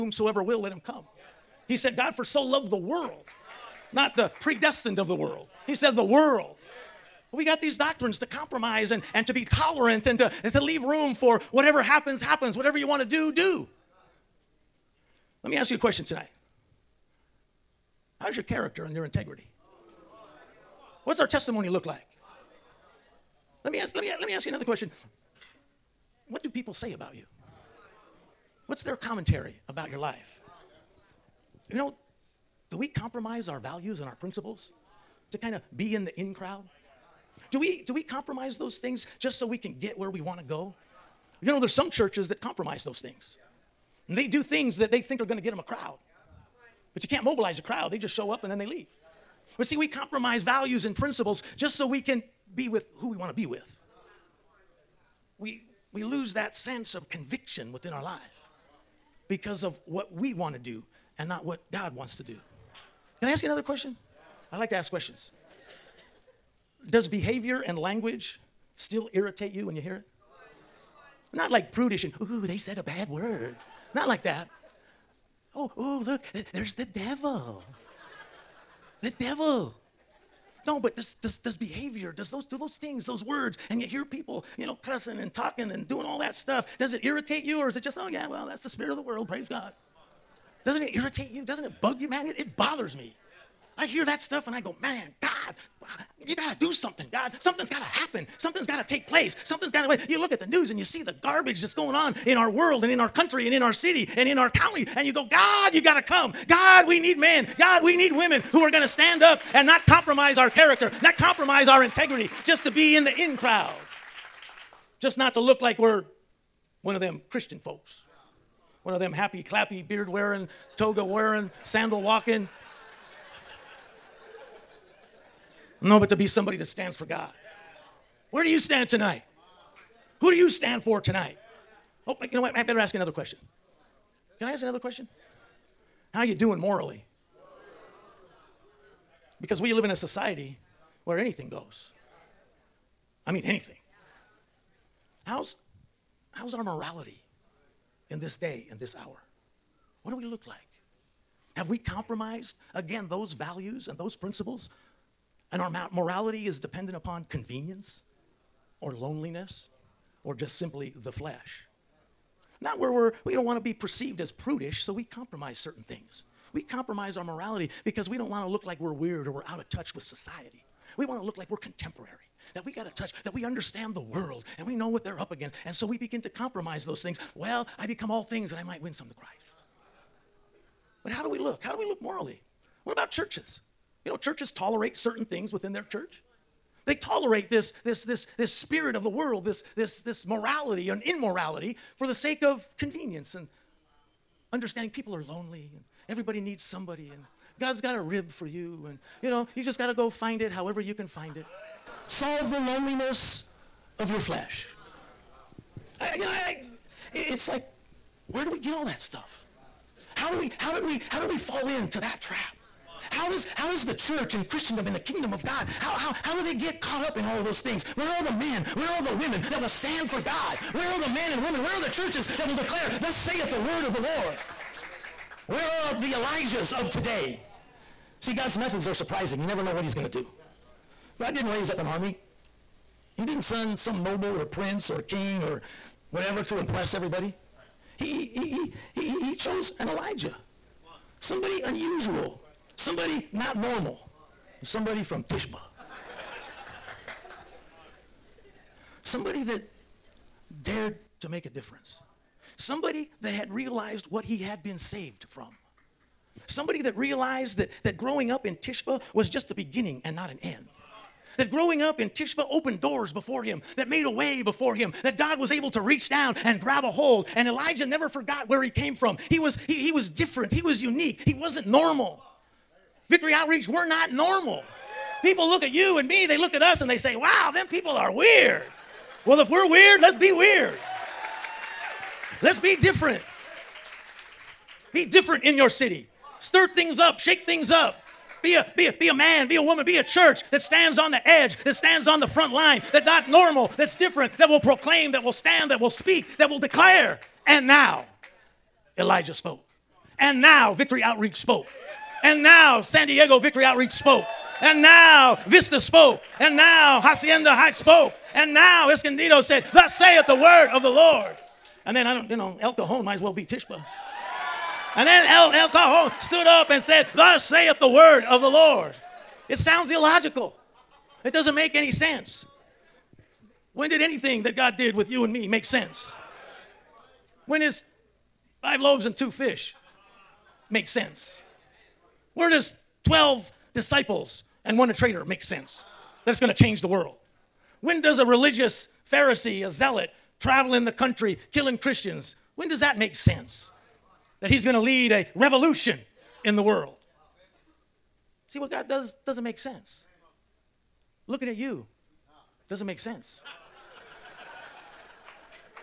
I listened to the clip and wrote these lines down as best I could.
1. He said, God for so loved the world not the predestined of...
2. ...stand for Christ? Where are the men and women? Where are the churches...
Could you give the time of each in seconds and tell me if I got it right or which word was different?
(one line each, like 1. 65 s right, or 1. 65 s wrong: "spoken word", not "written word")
1. 1 s right
2. 219 s wrong: "God", not "Christ".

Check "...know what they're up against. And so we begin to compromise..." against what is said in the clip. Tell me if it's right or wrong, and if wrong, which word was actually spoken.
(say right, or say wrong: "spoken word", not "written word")
right.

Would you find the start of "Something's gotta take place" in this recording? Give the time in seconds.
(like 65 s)
98 s.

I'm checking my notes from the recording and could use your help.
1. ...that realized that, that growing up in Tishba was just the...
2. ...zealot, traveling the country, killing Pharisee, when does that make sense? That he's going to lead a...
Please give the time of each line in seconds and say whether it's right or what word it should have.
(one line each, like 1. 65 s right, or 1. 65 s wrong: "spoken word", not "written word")
1. 256 s right
2. 339 s wrong: "Christians", not "Pharisee".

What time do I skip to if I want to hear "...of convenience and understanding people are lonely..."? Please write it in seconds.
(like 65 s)
192 s.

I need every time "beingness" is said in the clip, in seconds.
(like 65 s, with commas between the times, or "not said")
not said.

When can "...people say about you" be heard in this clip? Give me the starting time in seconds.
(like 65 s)
26 s.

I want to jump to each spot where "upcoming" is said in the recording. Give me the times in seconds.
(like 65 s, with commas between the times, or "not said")
not said.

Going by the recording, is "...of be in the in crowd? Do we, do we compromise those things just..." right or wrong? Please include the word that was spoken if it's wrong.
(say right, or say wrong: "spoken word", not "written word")
right.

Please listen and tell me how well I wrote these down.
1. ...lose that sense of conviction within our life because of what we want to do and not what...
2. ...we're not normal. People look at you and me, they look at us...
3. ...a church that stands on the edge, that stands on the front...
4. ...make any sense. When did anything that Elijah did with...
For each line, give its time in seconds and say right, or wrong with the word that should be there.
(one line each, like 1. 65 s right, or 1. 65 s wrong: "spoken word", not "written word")
1. 56 s right
2. 273 s right
3. 289 s right
4. 321 s wrong: "God", not "Elijah".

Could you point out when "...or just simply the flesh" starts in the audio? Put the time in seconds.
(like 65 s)
160 s.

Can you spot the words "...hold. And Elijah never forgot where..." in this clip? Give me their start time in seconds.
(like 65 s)
266 s.